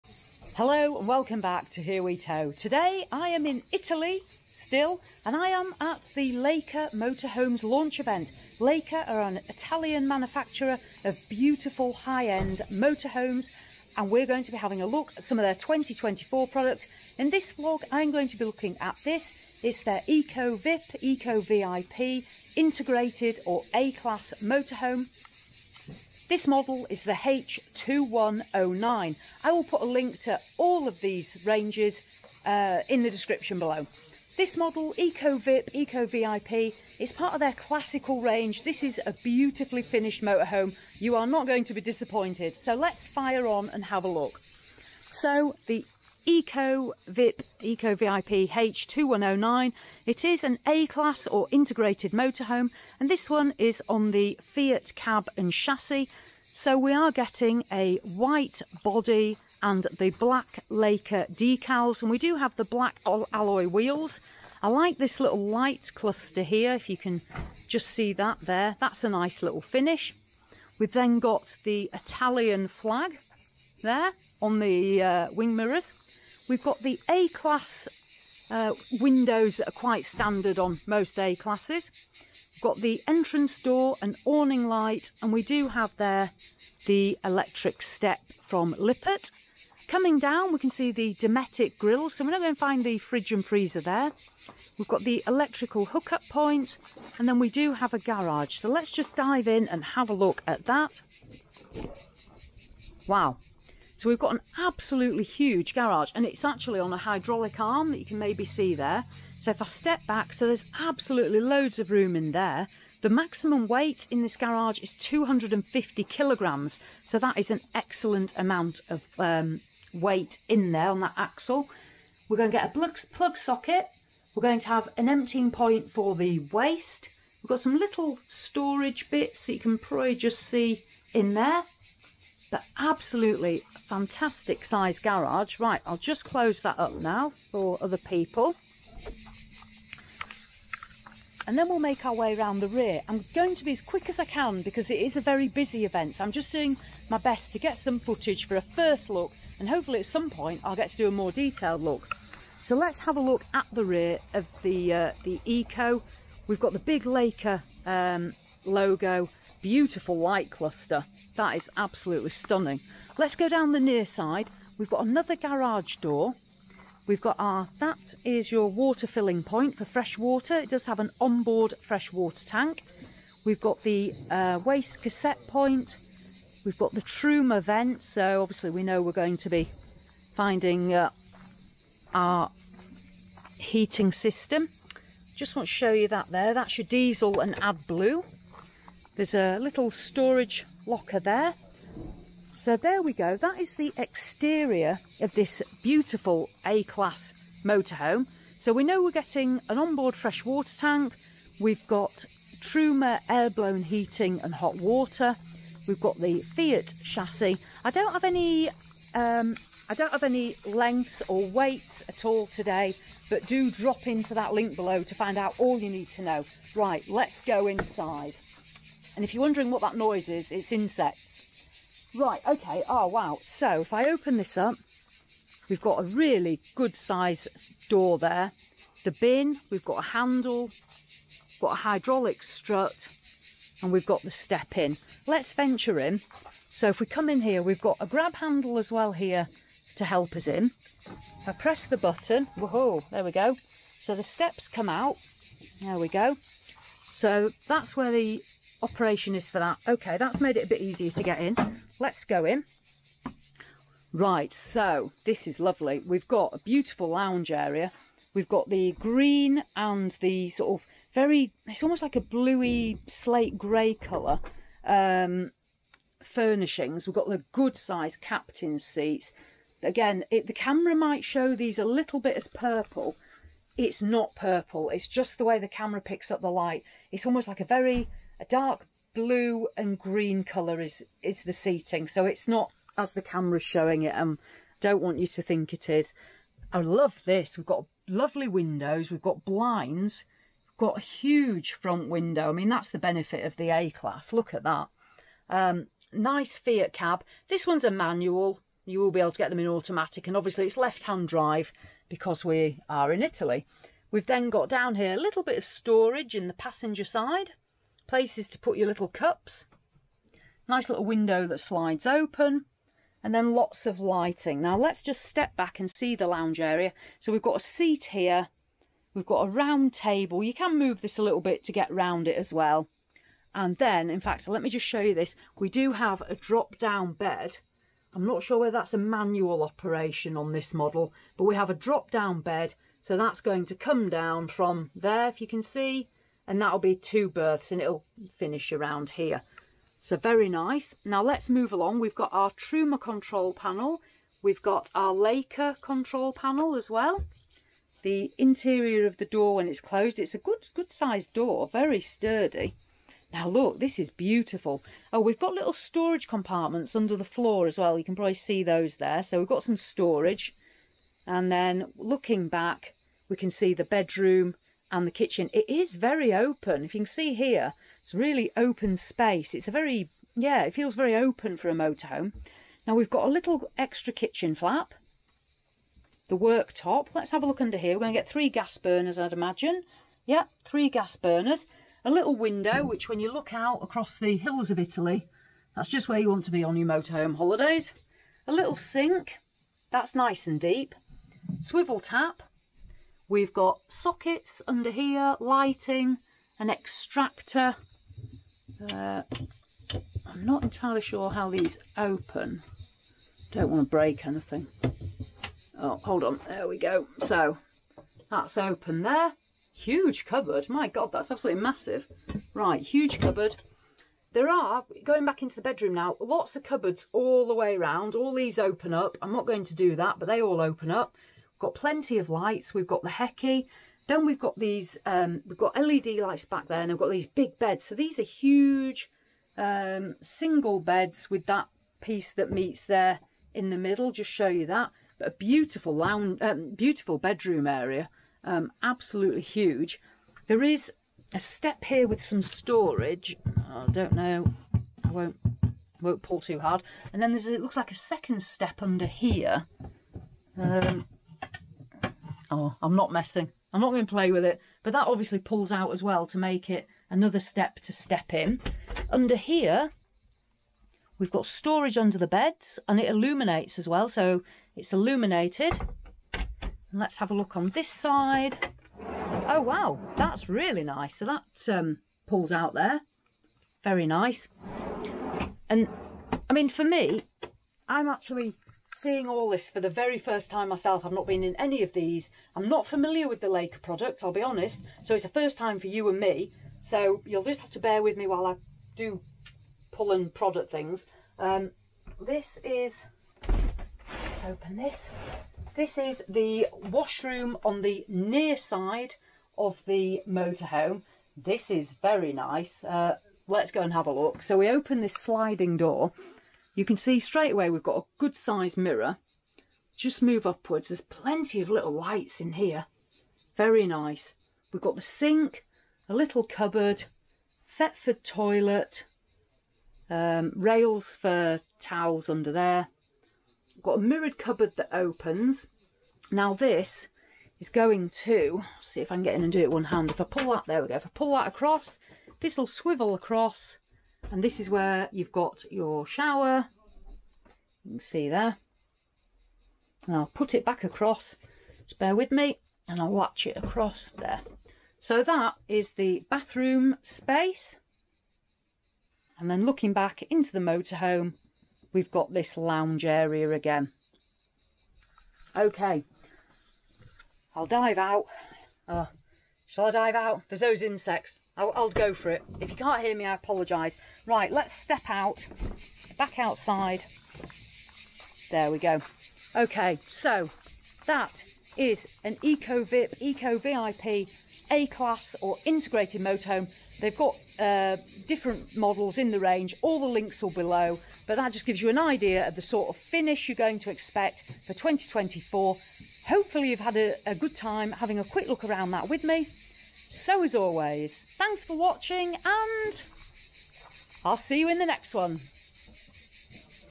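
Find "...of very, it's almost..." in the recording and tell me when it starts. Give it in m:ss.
4:20.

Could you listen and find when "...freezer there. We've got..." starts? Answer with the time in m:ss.
1:33.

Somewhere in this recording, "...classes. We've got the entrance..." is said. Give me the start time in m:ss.
1:21.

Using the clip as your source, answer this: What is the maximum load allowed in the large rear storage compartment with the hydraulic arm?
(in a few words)
250 kilograms.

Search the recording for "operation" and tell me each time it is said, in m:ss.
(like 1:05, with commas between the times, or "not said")
4:08, 5:29.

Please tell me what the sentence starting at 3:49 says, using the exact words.
The bin, we've got a handle, got a hydraulic strut, and we've got the step in.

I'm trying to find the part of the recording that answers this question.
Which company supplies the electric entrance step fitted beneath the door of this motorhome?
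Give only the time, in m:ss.
1:28.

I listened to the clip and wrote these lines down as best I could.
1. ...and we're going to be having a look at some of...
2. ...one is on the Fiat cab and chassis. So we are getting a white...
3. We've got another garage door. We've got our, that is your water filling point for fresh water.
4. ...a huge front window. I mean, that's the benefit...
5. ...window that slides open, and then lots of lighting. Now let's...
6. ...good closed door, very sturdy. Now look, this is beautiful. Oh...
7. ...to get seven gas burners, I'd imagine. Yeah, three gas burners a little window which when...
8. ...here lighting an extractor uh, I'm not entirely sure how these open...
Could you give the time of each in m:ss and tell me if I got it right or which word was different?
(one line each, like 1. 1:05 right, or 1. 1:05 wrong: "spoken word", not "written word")
1. 0:13 right
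2. 0:53 right
3. 2:44 right
4. 4:50 right
5. 5:11 right
6. 5:50 wrong: "sized", not "closed"
7. 6:18 wrong: "three", not "seven"
8. 6:34 right.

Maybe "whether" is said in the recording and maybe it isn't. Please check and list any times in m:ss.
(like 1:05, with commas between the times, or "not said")
5:28.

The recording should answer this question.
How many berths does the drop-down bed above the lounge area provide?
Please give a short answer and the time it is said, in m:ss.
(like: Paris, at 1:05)
Two, at 5:36.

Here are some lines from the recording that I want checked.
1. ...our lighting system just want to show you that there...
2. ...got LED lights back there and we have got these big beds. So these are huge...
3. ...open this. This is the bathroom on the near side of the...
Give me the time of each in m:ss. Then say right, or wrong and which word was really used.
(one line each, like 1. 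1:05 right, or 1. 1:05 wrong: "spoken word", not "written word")
1. 3:02 wrong: "heating", not "lighting"
2. 7:05 right
3. 8:14 wrong: "washroom", not "bathroom".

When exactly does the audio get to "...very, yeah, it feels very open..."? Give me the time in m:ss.
6:09.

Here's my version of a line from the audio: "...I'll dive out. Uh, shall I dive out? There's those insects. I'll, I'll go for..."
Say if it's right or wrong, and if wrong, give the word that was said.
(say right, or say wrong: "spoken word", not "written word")
right.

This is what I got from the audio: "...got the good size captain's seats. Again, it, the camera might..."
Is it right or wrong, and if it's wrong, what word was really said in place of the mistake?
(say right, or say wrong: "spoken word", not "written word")
right.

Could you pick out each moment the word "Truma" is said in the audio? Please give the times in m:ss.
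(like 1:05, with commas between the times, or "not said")
2:57, 3:22, 5:42.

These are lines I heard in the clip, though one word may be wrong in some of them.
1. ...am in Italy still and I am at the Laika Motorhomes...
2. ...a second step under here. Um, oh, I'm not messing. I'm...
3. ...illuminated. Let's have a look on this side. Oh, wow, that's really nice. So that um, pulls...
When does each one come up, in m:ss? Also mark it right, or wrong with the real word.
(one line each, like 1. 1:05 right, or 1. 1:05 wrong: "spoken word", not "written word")
1. 0:03 right
2. 7:27 right
3. 7:44 right.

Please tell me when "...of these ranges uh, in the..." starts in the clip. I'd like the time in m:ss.
0:30.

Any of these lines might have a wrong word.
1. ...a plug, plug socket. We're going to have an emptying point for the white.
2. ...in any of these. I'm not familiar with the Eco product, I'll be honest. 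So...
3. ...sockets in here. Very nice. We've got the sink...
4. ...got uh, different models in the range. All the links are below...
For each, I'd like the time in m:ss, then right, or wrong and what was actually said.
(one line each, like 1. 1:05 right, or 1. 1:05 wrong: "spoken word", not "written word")
1. 2:02 wrong: "waste", not "white"
2. 8:01 wrong: "Laika", not "Eco"
3. 8:31 wrong: "lights", not "sockets"
4. 9:37 right.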